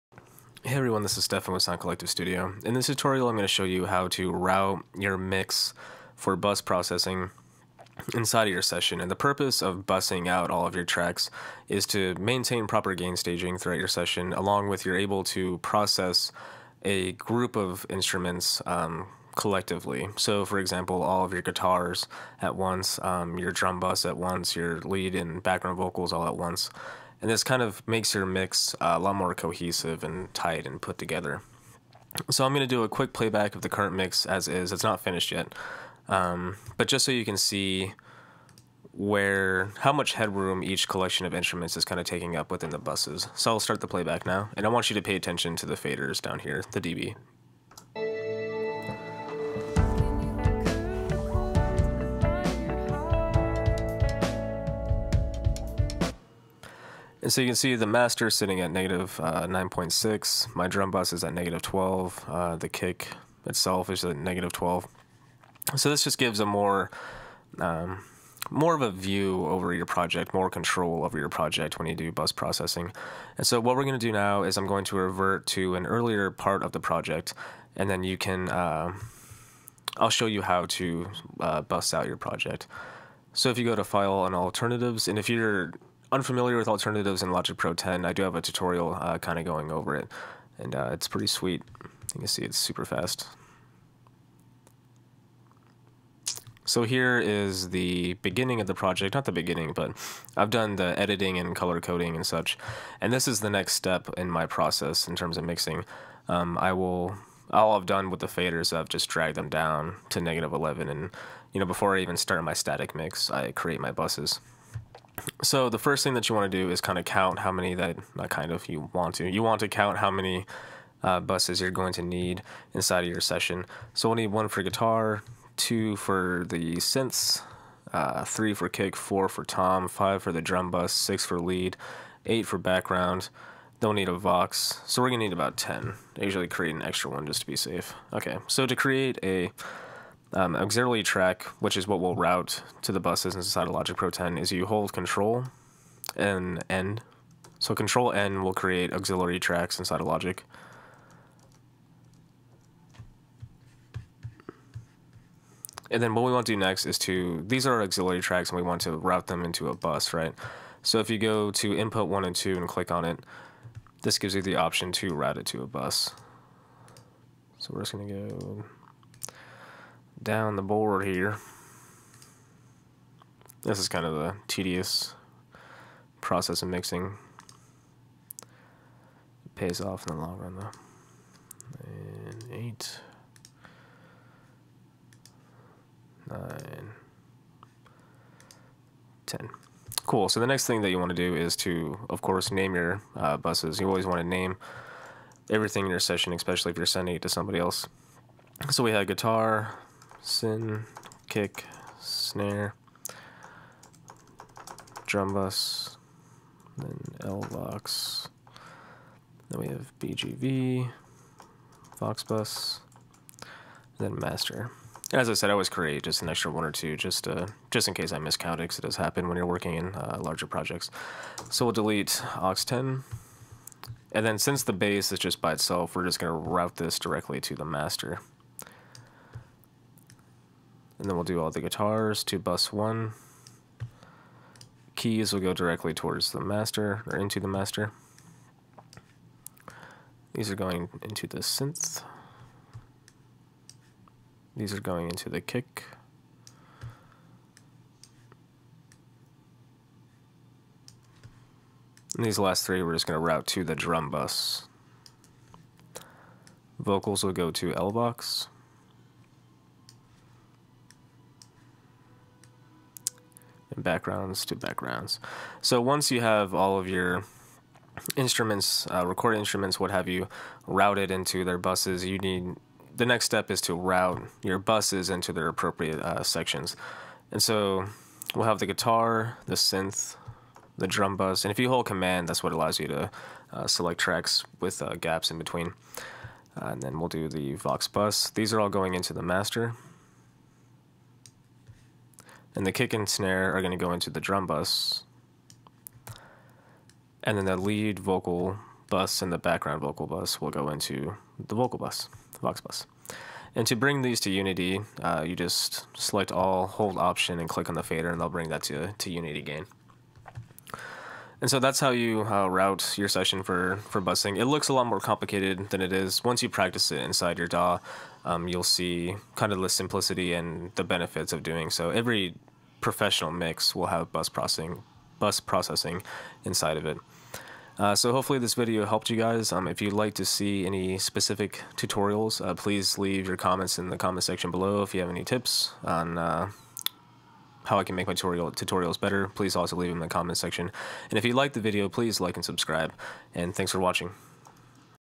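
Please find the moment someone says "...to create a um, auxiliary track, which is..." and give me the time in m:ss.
2:18.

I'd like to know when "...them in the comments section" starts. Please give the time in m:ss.
5:39.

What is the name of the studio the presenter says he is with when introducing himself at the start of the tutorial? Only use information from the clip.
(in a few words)
Sound Collective Studio.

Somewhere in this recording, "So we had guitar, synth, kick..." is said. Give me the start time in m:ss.
3:18.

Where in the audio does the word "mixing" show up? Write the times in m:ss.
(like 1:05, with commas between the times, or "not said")
1:45, 2:56.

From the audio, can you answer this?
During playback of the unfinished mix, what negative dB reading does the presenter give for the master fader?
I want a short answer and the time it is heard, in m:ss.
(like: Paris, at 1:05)
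-9.6, at 0:59.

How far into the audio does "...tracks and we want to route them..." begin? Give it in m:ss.
2:38.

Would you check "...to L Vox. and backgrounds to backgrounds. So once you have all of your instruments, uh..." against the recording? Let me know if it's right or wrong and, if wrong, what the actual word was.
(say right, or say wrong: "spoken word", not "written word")
right.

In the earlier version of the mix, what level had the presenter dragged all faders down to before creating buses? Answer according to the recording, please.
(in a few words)
-11.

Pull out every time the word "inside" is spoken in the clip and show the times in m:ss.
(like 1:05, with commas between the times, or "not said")
0:08, 2:02, 2:23, 2:29, 5:17, 5:26.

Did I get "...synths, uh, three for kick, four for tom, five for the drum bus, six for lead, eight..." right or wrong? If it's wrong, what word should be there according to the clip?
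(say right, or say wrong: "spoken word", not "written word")
right.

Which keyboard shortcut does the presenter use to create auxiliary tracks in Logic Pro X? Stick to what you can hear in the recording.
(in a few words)
Control and N.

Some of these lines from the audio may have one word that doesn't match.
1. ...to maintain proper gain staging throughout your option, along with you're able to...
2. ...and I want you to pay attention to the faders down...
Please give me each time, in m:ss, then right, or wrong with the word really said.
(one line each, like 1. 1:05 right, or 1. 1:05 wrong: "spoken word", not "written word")
1. 0:11 wrong: "session", not "option"
2. 0:44 right.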